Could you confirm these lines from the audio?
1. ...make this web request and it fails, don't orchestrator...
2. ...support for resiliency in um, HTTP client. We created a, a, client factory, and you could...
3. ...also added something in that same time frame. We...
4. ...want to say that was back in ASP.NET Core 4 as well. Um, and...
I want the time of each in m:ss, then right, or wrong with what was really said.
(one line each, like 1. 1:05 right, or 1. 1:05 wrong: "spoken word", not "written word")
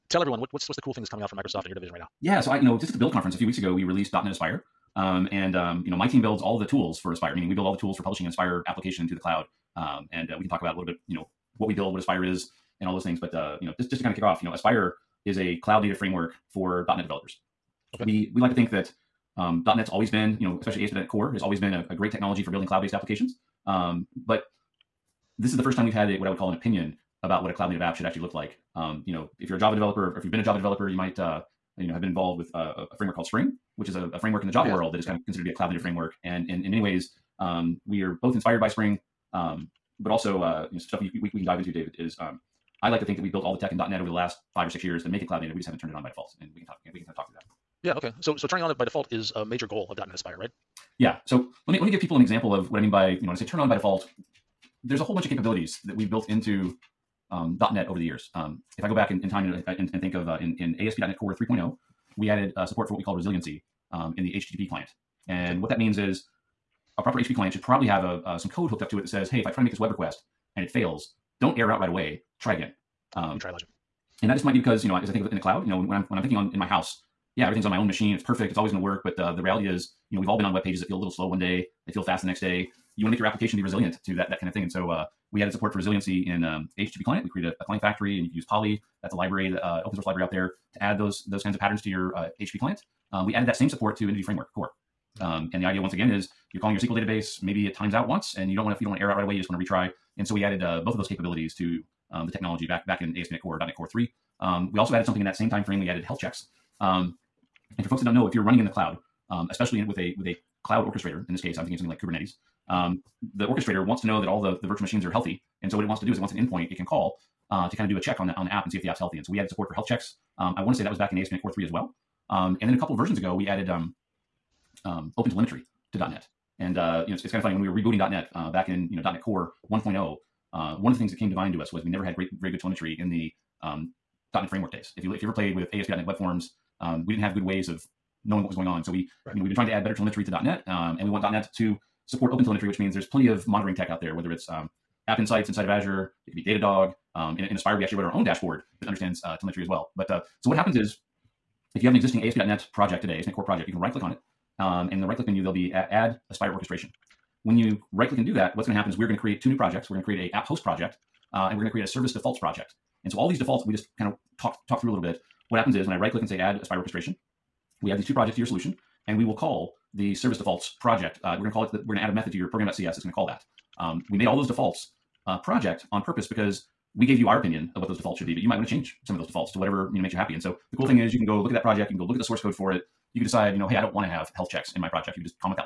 1. 1:09 wrong: "error", not "orchestrator"
2. 1:25 right
3. 1:44 right
4. 2:00 wrong: "3", not "4".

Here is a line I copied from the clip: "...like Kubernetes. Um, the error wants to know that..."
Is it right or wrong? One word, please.
wrong.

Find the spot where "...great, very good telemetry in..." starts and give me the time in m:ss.
2:12.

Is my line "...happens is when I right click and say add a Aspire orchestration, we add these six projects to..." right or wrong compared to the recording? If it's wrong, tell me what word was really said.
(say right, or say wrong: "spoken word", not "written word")
wrong: "two", not "six".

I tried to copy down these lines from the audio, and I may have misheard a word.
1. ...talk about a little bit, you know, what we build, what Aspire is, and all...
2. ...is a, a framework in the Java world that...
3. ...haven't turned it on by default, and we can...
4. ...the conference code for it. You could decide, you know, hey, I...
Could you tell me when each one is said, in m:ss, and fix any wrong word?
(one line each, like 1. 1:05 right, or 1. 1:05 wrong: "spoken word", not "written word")
1. 0:10 right
2. 0:33 right
3. 0:45 right
4. 3:02 wrong: "source", not "conference".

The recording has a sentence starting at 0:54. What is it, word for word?
There's a whole bunch of capabilities that we've built into um, .NET over the years.